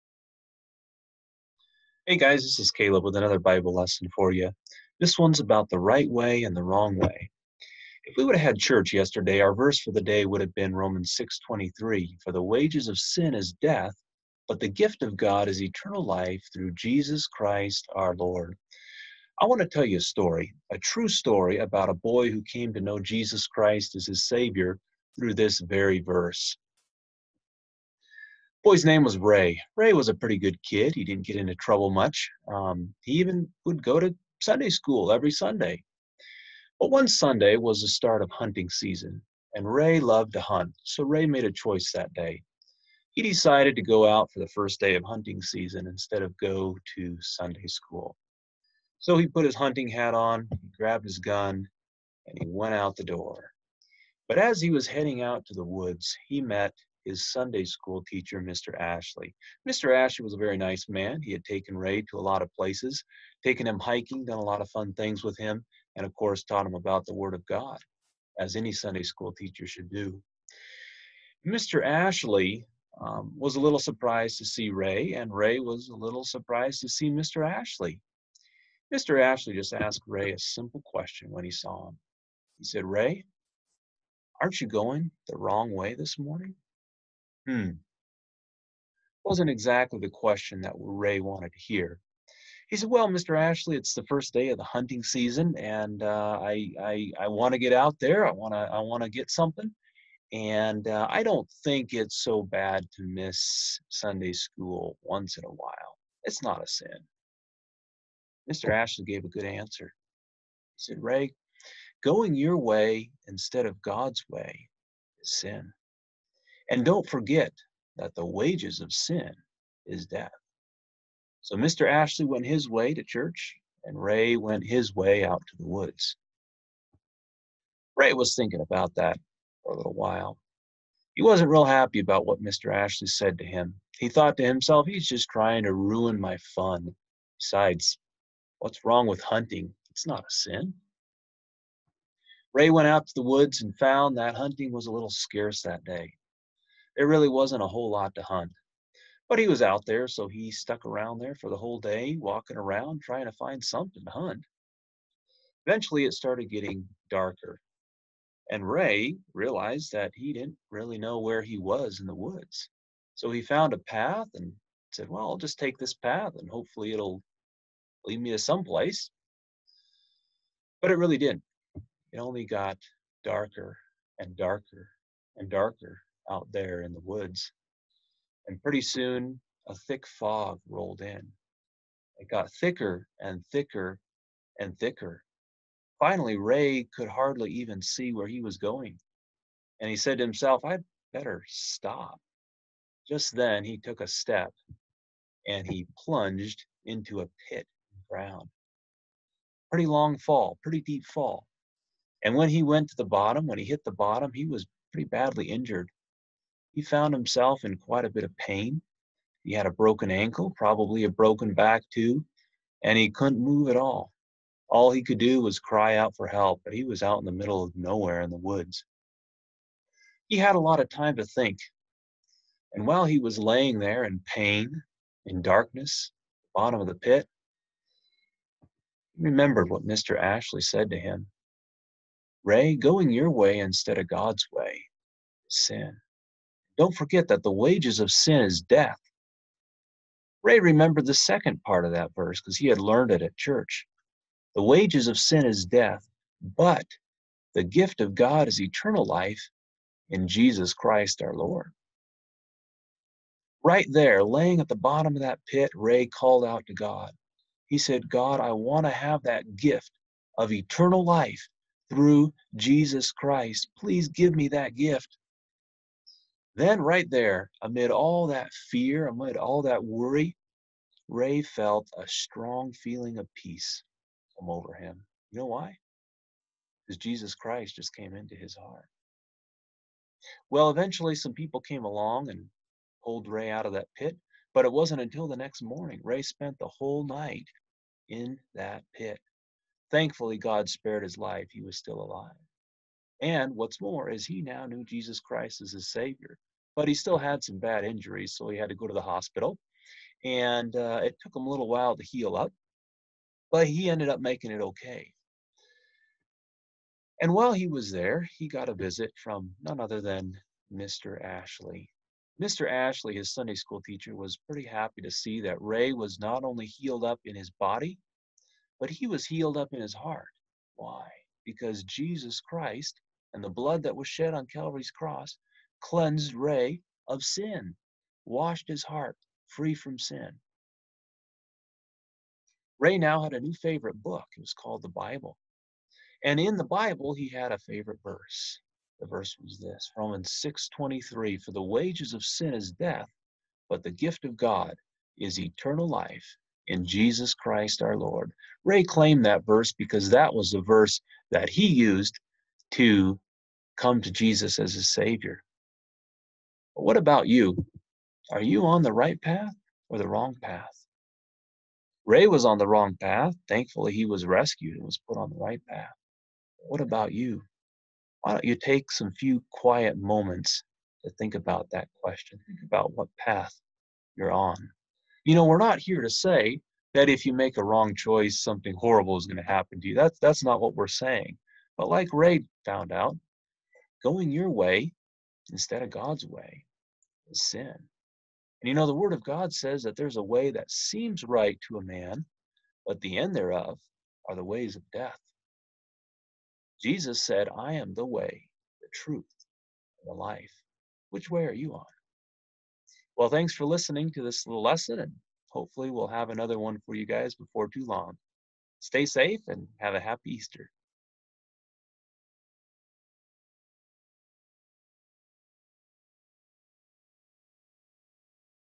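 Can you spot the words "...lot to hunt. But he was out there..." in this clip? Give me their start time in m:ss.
2:27.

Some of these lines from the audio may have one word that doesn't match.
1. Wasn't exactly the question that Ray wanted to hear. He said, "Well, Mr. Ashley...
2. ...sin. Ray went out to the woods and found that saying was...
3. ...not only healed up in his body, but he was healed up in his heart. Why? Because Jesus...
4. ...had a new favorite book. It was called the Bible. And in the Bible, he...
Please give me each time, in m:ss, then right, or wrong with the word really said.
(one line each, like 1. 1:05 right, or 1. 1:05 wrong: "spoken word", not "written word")
1. 1:29 right
2. 2:20 wrong: "hunting", not "saying"
3. 5:16 right
4. 5:33 right.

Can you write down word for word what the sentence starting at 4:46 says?
Ray spent the whole night in that pit.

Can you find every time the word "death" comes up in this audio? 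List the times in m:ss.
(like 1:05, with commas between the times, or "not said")
0:13, 2:00, 3:58, 4:05, 5:42, 6:34.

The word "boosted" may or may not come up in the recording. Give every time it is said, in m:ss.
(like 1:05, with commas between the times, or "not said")
not said.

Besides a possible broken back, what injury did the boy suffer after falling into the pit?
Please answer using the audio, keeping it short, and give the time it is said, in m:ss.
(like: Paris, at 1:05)
Broken ankle, at 3:29.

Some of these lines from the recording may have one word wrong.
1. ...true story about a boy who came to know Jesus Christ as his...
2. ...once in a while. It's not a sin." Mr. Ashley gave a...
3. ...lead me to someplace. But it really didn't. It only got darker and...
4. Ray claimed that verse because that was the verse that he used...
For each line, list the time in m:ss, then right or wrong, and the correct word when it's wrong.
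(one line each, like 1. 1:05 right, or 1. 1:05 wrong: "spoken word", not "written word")
1. 0:20 right
2. 1:45 right
3. 2:48 right
4. 5:48 right.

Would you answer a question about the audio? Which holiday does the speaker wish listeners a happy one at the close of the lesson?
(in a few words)
Easter.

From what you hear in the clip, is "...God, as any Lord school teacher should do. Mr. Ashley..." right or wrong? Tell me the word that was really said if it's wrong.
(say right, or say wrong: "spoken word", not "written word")
wrong: "Sunday", not "Lord".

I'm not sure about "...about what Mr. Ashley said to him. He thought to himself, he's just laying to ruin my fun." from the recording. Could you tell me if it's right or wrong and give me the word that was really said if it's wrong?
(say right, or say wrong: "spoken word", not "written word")
wrong: "trying", not "laying".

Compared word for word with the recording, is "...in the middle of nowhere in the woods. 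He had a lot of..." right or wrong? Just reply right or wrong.
right.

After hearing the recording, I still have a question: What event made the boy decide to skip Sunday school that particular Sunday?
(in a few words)
First day of hunting season.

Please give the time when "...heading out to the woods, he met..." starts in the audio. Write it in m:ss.
0:54.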